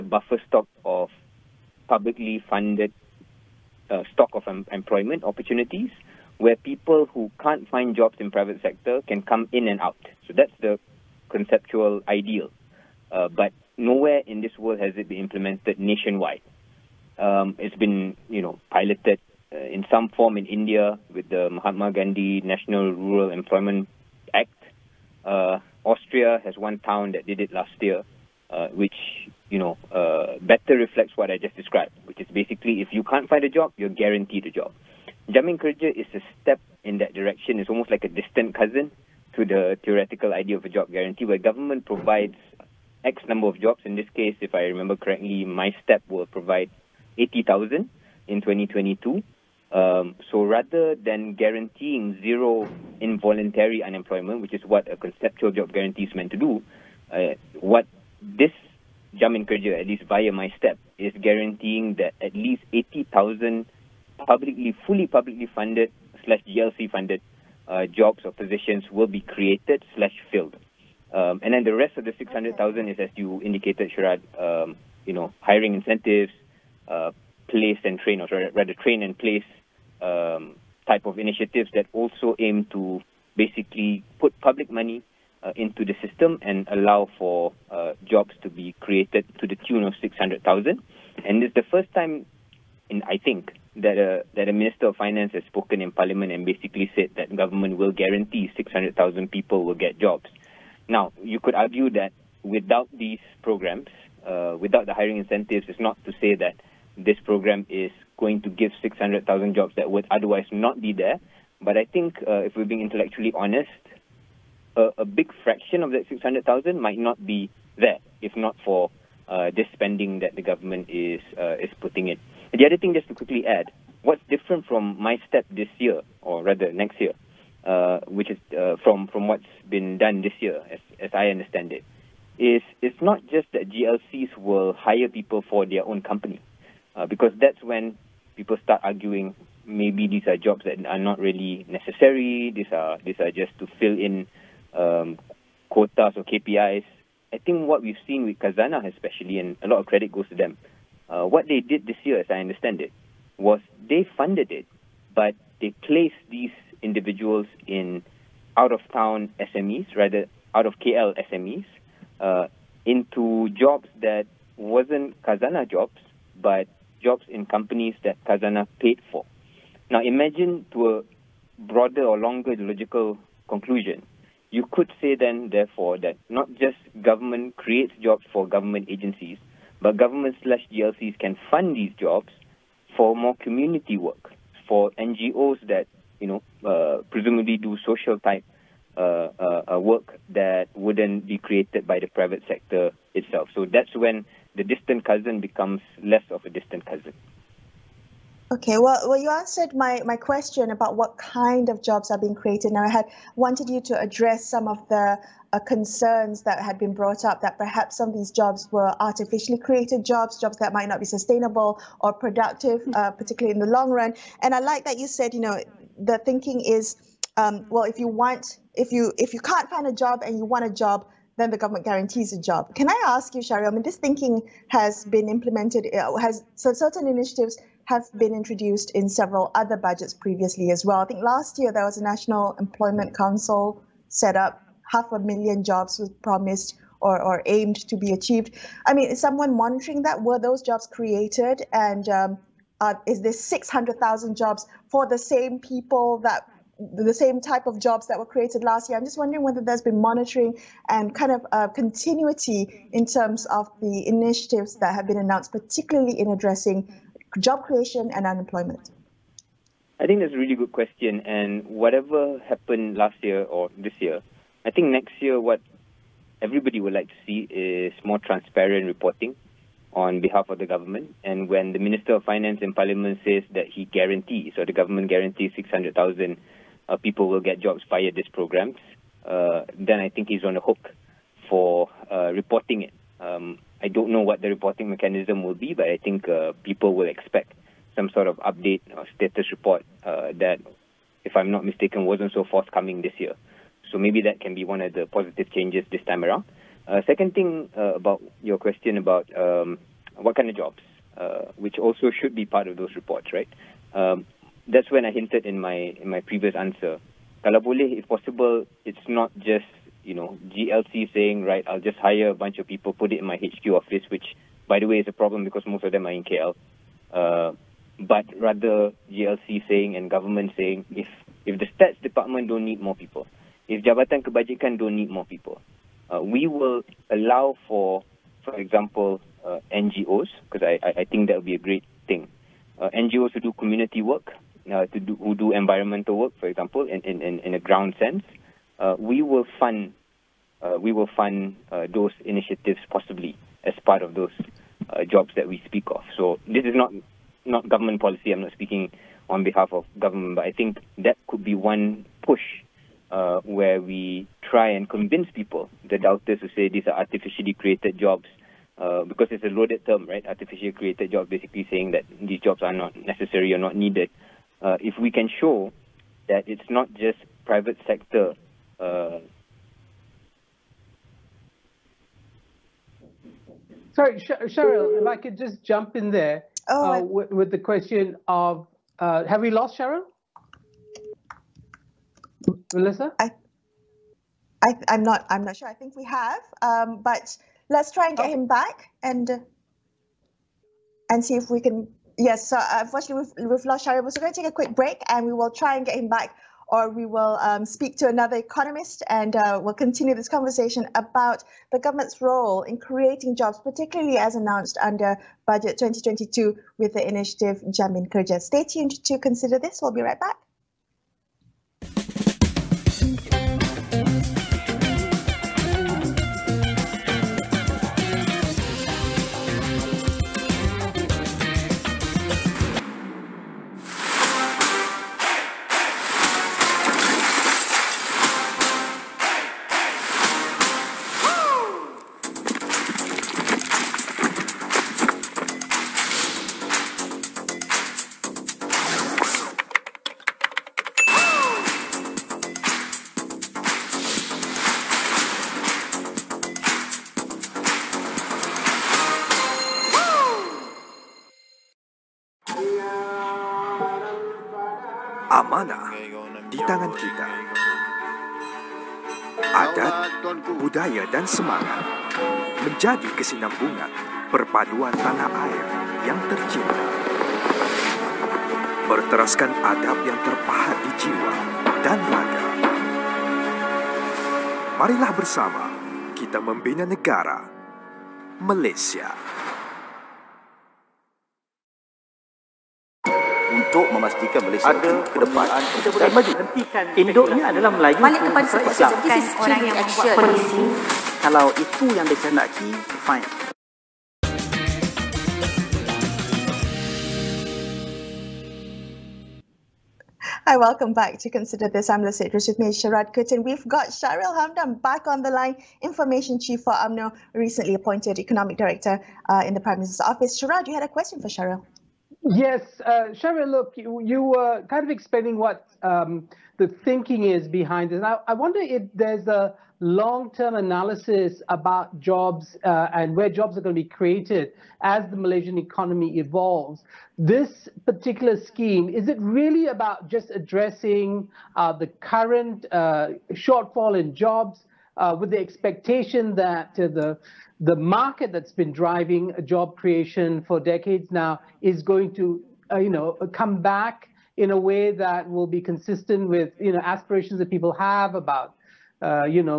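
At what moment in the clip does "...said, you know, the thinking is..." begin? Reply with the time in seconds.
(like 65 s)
215 s.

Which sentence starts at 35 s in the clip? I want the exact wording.
Jamin Kerja is a step in that direction.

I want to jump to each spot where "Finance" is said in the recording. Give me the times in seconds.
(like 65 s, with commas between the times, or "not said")
94 s, 272 s.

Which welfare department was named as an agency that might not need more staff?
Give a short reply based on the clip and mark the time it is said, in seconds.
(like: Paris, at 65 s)
Jabatan Kebajikan, at 323 s.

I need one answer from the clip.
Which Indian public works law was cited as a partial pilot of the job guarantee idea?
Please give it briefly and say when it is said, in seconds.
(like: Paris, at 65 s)
Mahatma Gandhi National Rural Employment Act, at 21 s.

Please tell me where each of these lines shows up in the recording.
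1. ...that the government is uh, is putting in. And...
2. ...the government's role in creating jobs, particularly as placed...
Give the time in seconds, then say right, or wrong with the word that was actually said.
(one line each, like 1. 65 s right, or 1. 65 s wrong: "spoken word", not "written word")
1. 120 s right
2. 401 s wrong: "announced", not "placed".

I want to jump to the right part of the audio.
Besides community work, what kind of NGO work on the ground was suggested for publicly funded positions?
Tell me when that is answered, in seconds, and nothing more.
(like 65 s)
335 s.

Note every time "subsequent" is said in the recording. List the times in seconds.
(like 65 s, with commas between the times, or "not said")
not said.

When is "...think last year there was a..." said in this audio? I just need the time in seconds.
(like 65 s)
231 s.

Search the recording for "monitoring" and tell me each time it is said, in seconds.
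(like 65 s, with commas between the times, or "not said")
239 s, 250 s.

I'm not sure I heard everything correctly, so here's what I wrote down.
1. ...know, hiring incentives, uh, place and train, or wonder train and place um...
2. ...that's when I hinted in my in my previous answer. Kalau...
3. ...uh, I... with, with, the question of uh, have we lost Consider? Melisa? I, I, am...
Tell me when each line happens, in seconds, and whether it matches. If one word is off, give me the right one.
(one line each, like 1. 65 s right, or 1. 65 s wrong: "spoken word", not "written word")
1. 75 s wrong: "rather", not "wonder"
2. 304 s right
3. 376 s wrong: "Shahril", not "Consider".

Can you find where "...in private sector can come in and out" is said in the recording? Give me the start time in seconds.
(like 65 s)
8 s.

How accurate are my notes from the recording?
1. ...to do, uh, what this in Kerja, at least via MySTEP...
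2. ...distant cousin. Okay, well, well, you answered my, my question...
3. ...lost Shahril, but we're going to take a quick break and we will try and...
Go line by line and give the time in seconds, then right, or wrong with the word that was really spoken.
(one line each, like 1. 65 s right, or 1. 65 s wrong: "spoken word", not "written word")
1. 56 s right
2. 196 s right
3. 393 s right.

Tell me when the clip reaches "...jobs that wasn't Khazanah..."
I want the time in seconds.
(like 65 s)
163 s.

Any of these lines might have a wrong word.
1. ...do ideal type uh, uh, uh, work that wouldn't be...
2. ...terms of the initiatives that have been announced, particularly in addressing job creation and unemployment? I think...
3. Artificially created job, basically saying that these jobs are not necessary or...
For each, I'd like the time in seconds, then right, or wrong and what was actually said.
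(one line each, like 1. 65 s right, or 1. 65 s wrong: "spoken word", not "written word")
1. 187 s wrong: "social", not "ideal"
2. 253 s right
3. 360 s right.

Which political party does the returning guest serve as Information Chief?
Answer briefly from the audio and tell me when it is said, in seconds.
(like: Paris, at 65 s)
UMNO, at 506 s.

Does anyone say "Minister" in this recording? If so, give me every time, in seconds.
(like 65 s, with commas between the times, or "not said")
94 s, 271 s, 509 s.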